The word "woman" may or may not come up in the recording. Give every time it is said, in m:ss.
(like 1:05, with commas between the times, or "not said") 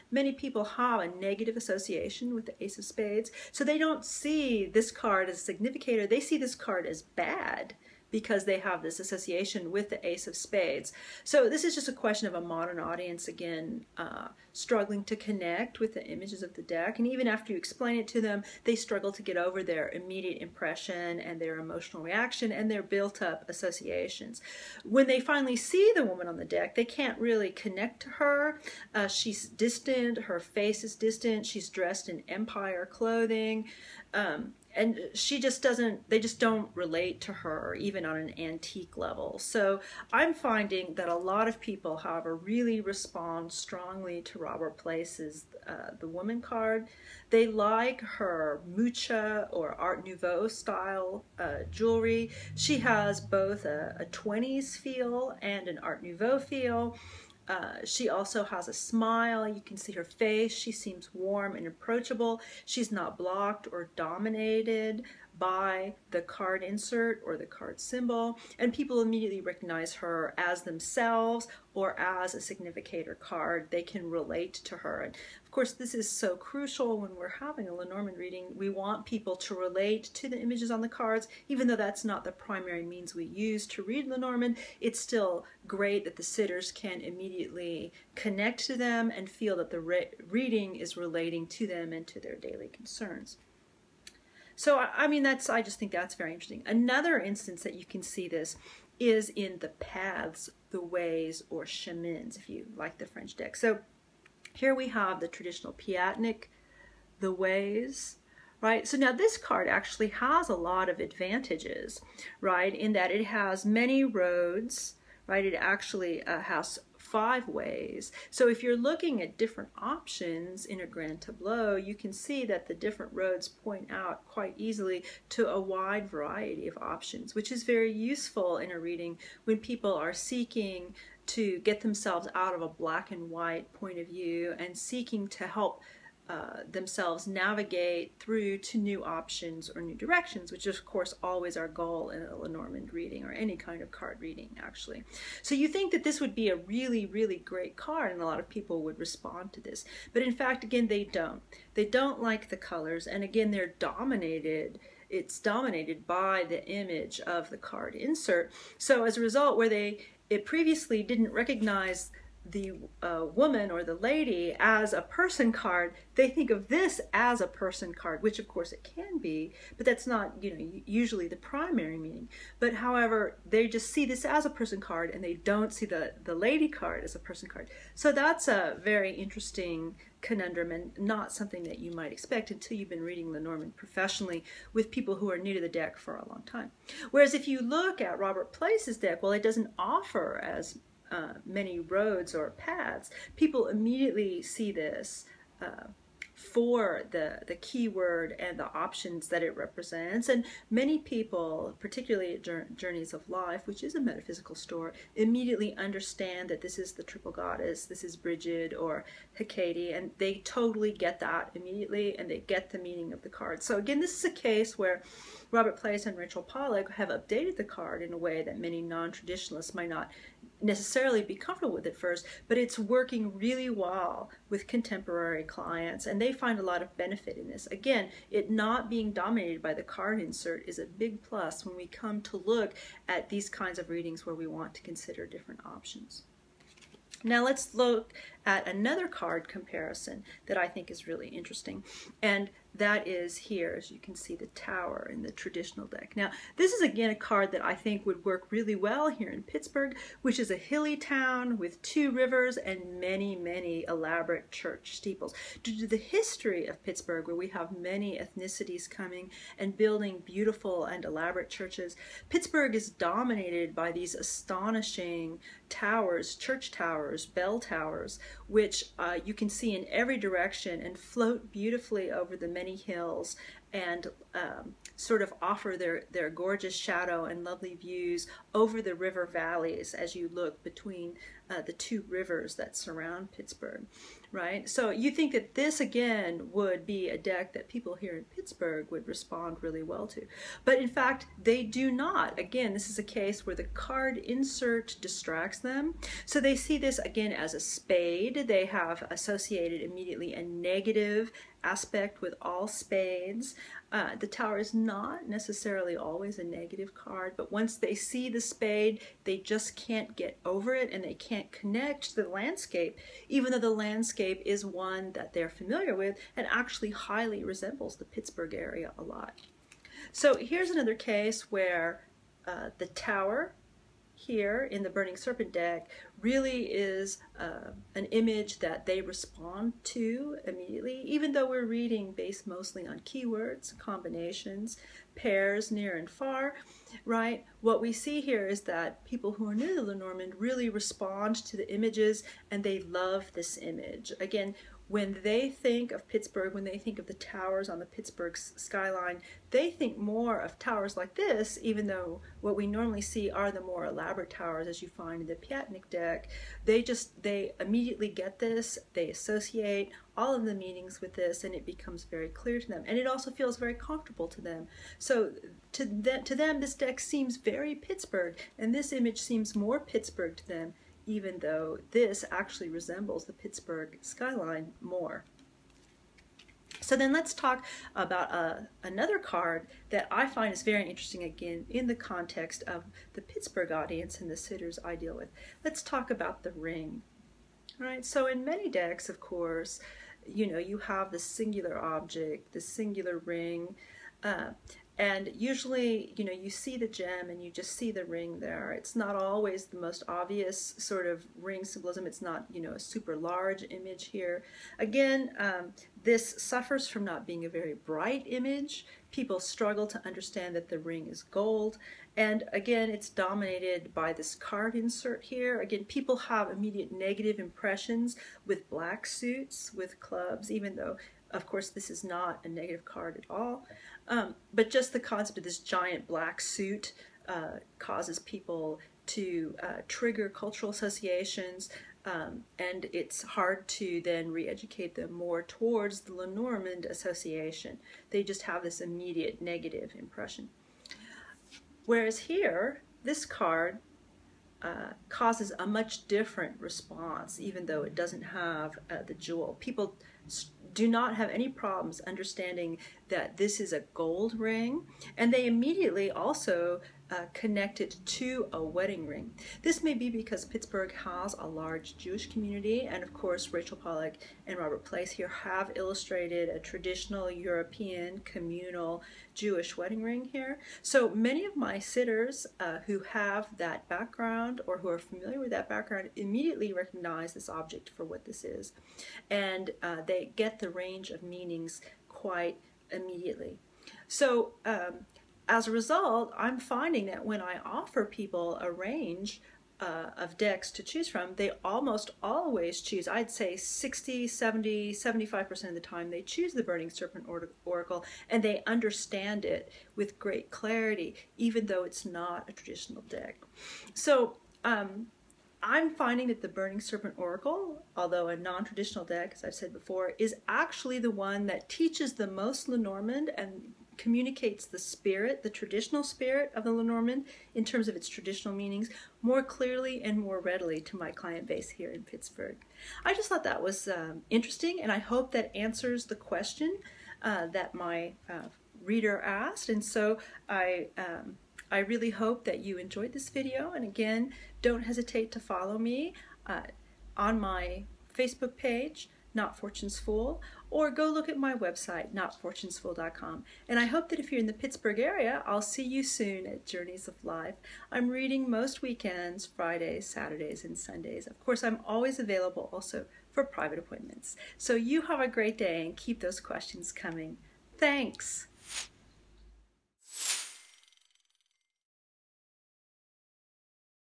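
0:26, 0:46, 2:43.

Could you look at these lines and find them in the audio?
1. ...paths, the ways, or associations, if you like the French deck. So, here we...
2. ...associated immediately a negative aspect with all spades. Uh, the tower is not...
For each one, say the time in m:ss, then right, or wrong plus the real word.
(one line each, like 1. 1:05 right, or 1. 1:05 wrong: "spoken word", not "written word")
1. 1:39 wrong: "chemins", not "associations"
2. 4:59 right.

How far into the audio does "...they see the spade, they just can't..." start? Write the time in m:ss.
5:07.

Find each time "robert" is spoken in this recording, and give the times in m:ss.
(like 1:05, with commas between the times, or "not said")
0:44, 3:08, 3:35, 7:44.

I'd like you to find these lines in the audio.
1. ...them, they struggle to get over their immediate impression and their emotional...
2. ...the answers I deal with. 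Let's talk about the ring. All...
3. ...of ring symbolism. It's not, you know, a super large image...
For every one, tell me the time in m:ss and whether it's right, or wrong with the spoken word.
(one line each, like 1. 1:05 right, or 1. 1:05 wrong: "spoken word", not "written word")
1. 0:18 right
2. 6:24 wrong: "sitters", not "answers"
3. 6:41 right.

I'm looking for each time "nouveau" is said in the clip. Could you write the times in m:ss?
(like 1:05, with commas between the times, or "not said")
0:50, 0:56.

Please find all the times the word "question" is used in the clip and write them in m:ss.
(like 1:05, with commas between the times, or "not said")
0:11, 8:46, 9:16.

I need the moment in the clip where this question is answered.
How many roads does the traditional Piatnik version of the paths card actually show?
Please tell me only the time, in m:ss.
1:57.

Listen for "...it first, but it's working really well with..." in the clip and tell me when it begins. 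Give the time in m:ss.
3:41.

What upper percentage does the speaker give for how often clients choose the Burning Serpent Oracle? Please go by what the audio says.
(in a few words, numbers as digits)
75%.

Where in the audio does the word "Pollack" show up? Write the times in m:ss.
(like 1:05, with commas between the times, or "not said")
3:36, 7:43.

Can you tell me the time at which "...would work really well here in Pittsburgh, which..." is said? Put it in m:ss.
4:08.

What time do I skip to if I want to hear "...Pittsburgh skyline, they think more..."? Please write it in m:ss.
5:47.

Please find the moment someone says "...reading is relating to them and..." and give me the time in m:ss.
1:30.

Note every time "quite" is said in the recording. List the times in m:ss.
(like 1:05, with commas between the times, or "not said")
2:04, 8:02.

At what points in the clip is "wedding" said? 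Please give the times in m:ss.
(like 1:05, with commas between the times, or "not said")
7:38, 7:49.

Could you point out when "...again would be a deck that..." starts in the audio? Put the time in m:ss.
4:45.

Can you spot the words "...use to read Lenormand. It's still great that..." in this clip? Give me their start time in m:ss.
1:23.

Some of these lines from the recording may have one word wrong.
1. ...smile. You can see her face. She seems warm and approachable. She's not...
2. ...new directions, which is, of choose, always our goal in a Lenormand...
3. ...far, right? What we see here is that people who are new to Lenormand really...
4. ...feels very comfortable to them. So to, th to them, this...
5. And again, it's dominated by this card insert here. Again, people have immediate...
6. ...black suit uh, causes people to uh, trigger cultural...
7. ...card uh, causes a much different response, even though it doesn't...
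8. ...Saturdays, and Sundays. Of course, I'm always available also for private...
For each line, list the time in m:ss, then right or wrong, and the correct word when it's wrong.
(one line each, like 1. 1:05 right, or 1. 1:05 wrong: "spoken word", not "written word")
1. 0:58 right
2. 2:19 wrong: "course", not "choose"
3. 5:36 right
4. 6:03 right
5. 6:52 right
6. 7:06 right
7. 7:23 right
8. 9:10 right.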